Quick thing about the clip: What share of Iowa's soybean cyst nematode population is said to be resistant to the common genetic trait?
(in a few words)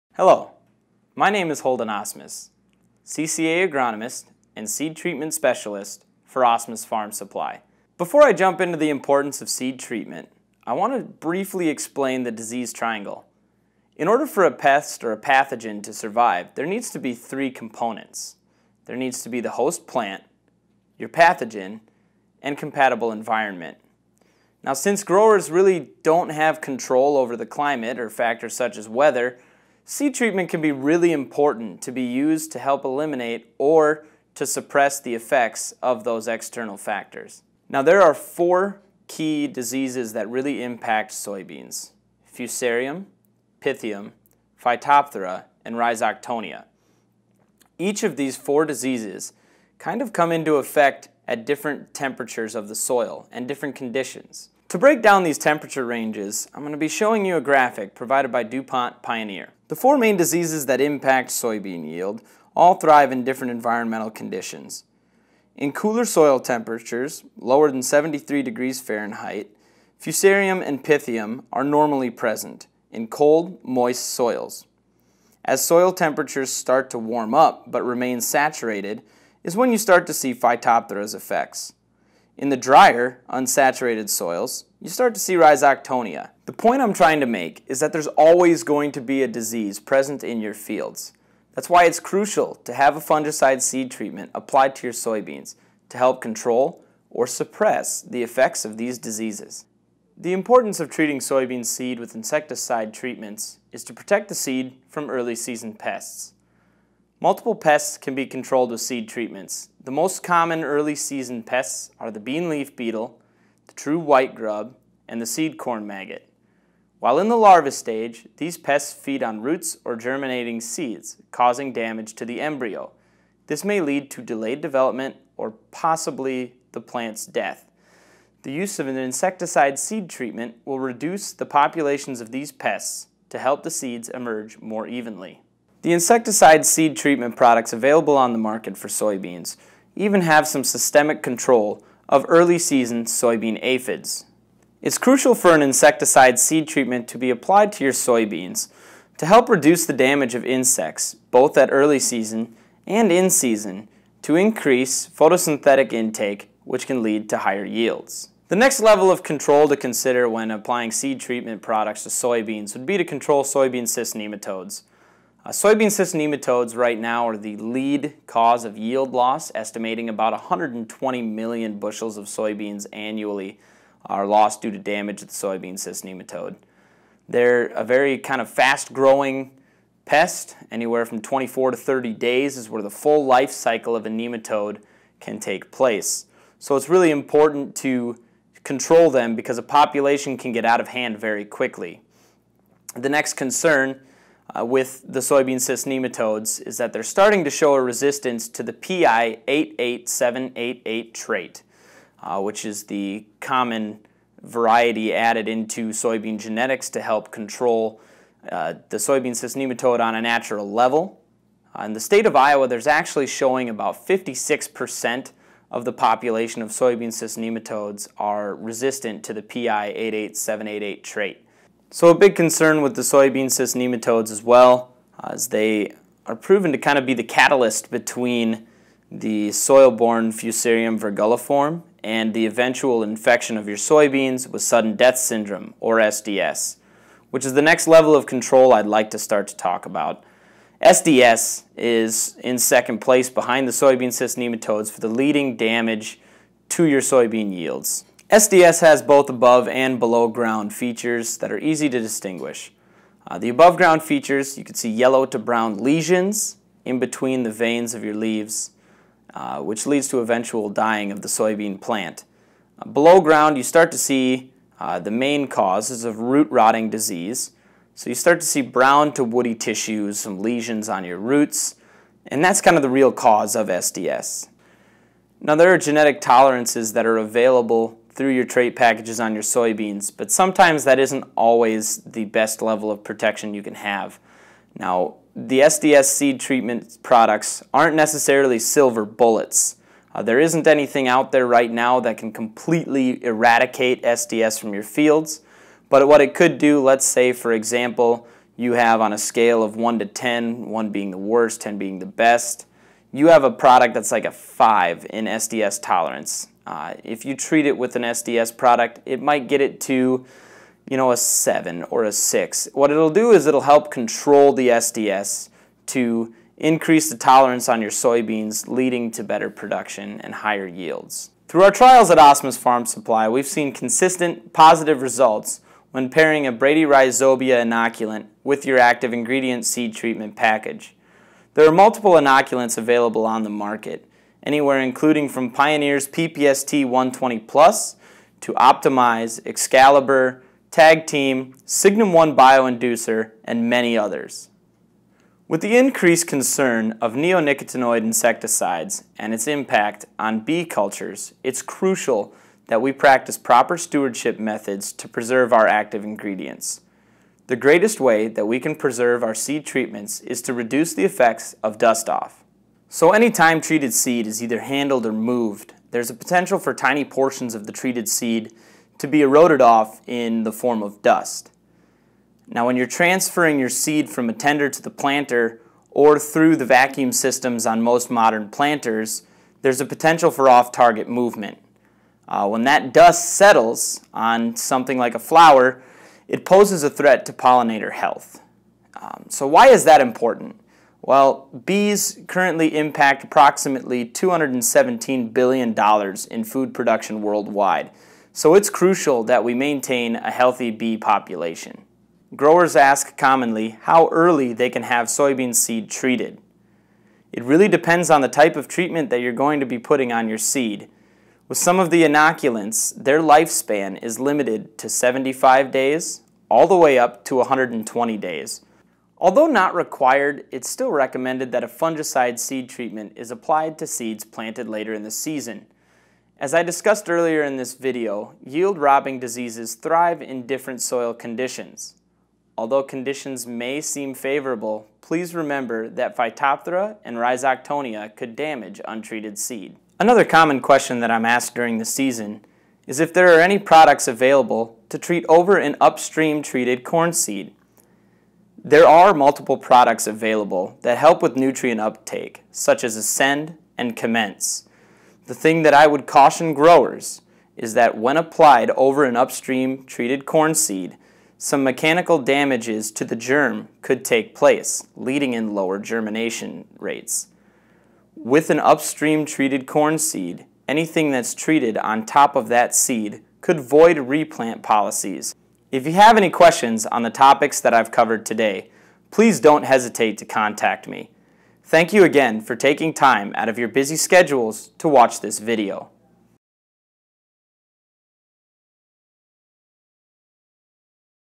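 56%.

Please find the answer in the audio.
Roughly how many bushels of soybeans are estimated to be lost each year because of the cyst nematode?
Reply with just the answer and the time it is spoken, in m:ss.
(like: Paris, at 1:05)
120 million, at 2:50.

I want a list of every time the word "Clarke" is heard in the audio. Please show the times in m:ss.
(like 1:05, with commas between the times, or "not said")
not said.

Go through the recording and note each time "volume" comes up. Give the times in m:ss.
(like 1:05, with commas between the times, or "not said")
not said.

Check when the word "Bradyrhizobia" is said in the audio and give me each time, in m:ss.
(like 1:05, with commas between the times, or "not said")
5:26.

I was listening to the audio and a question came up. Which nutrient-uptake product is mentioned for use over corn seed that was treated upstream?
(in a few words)
Ascend.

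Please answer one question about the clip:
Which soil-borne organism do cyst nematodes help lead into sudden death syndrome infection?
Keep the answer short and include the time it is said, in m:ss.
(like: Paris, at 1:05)
Fusarium virguliforme, at 3:50.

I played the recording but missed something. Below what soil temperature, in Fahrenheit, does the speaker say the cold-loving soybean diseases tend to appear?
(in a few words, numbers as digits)
73 degrees.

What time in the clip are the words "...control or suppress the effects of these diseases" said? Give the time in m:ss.
1:36.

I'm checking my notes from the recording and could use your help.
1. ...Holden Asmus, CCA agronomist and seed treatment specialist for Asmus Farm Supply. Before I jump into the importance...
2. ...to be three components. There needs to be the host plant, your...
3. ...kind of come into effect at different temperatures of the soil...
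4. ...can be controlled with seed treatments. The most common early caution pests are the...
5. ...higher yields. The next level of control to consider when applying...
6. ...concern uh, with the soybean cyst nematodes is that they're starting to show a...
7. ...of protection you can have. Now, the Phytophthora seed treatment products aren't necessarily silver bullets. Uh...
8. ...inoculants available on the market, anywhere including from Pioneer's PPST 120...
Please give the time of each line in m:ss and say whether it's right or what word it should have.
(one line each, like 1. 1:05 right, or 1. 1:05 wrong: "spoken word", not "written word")
1. 0:01 right
2. 0:16 right
3. 0:49 right
4. 1:47 wrong: "season", not "caution"
5. 2:37 right
6. 3:13 right
7. 4:42 wrong: "SDS", not "Phytophthora"
8. 5:32 right.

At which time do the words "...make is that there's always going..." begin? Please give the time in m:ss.
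1:27.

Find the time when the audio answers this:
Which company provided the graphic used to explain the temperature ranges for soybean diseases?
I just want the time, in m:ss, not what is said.
0:58.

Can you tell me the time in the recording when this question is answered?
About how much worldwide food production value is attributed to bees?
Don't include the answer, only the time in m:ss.
6:34.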